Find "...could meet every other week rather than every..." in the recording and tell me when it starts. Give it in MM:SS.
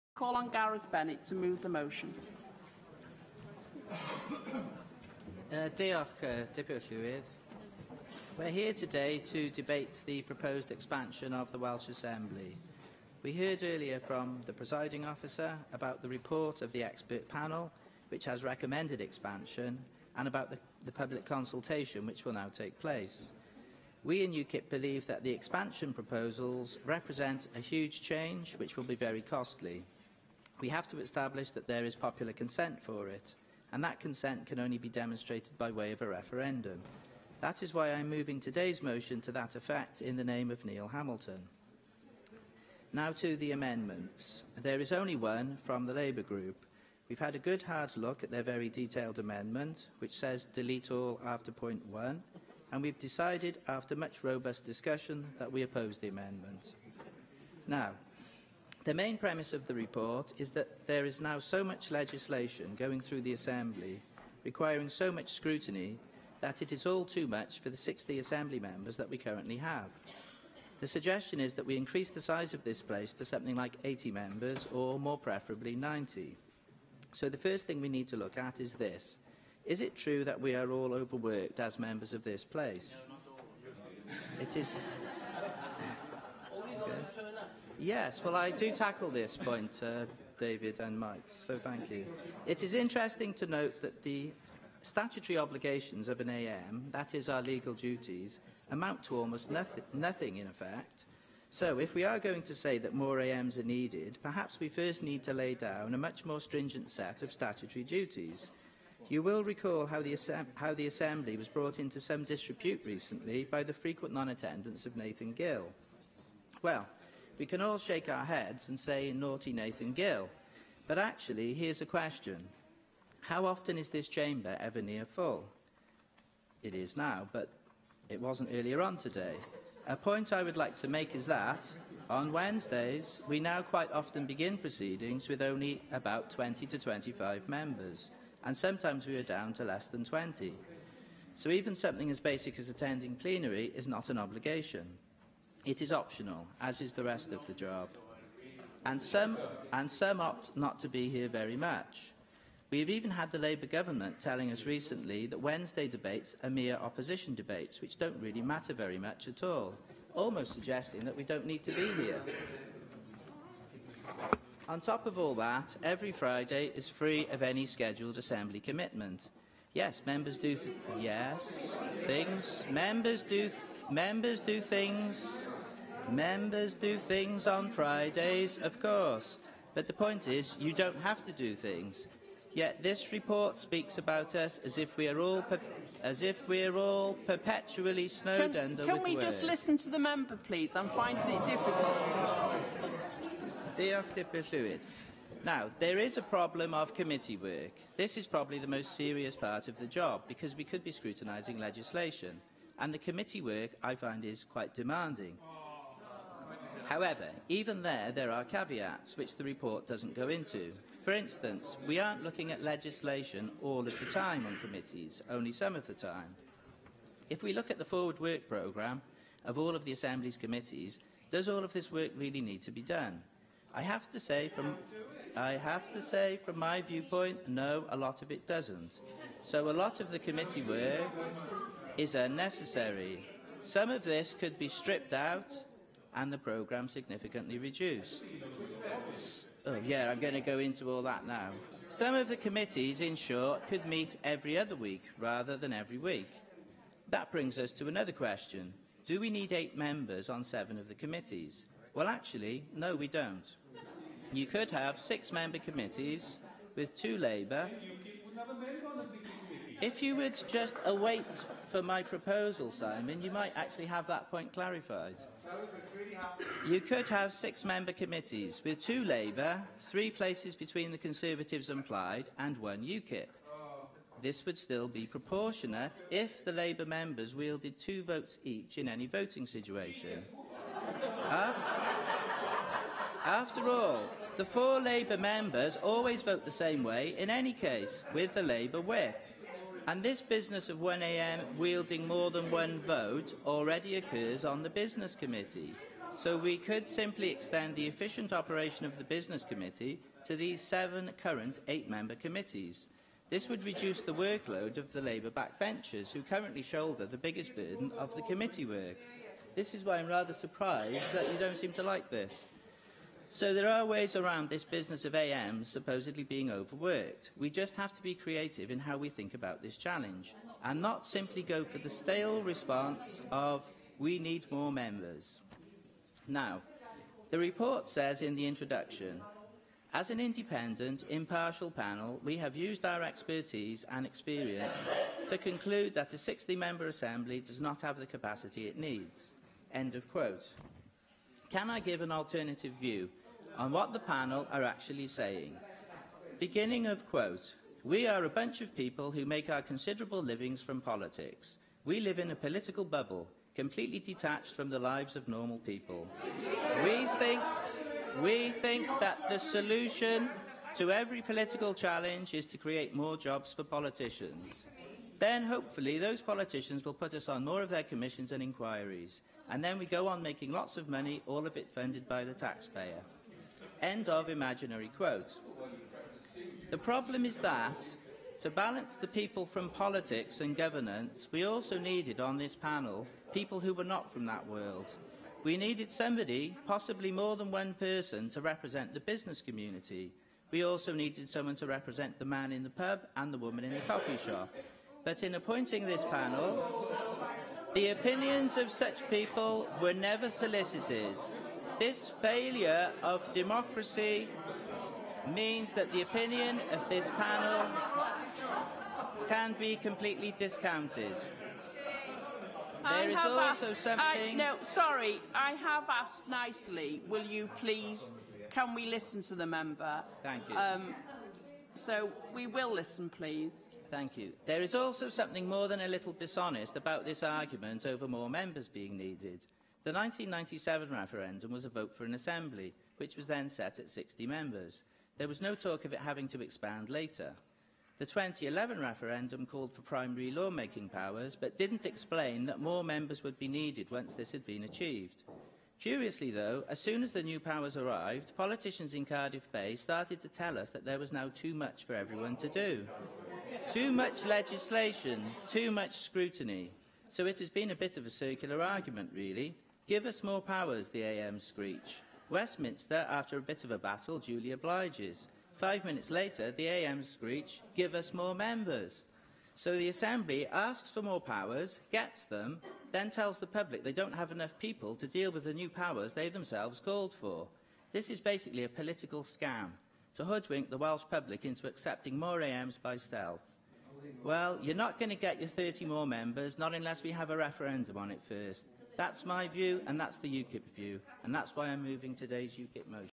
04:03.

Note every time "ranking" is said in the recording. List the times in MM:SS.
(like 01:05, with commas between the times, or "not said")
not said.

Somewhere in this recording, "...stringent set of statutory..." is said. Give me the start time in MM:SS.
01:46.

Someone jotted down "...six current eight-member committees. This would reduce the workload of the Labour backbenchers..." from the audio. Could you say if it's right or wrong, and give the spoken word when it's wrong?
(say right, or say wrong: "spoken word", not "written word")
wrong: "seven", not "six".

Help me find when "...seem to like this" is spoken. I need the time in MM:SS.
05:11.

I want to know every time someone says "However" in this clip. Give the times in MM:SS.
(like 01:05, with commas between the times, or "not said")
03:26.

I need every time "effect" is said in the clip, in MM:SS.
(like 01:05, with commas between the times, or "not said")
00:39, 01:40.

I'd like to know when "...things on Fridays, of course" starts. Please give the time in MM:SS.
02:56.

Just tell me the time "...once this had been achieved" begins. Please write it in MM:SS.
07:23.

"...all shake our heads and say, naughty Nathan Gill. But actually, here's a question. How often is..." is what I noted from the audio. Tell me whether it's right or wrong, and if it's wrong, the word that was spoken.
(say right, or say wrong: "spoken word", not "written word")
right.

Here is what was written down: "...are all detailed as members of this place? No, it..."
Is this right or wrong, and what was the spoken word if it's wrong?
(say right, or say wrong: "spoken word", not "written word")
wrong: "overworked", not "detailed".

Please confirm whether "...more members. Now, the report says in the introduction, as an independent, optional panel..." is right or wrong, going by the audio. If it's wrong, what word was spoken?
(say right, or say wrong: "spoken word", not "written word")
wrong: "impartial", not "optional".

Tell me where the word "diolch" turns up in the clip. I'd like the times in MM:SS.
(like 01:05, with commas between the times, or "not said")
00:05, 03:13.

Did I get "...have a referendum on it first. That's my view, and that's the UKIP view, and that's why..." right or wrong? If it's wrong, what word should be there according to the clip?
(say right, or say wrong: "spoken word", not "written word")
right.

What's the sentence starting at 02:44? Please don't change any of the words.
On top of all that, every Friday is free of any scheduled assembly commitment.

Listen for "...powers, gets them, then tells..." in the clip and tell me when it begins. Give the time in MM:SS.
07:51.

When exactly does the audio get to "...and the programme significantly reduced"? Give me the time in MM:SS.
03:56.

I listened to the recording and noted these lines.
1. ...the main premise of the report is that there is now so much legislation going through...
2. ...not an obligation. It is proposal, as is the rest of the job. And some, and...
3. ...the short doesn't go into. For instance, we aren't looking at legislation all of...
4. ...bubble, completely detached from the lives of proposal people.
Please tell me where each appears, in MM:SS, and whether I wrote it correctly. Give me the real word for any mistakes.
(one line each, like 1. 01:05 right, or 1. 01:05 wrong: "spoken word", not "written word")
1. 00:58 right
2. 02:23 wrong: "optional", not "proposal"
3. 03:29 wrong: "report", not "short"
4. 05:52 wrong: "normal", not "proposal".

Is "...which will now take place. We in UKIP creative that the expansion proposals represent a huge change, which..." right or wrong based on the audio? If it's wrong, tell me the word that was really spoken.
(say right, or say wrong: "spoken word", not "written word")
wrong: "believe", not "creative".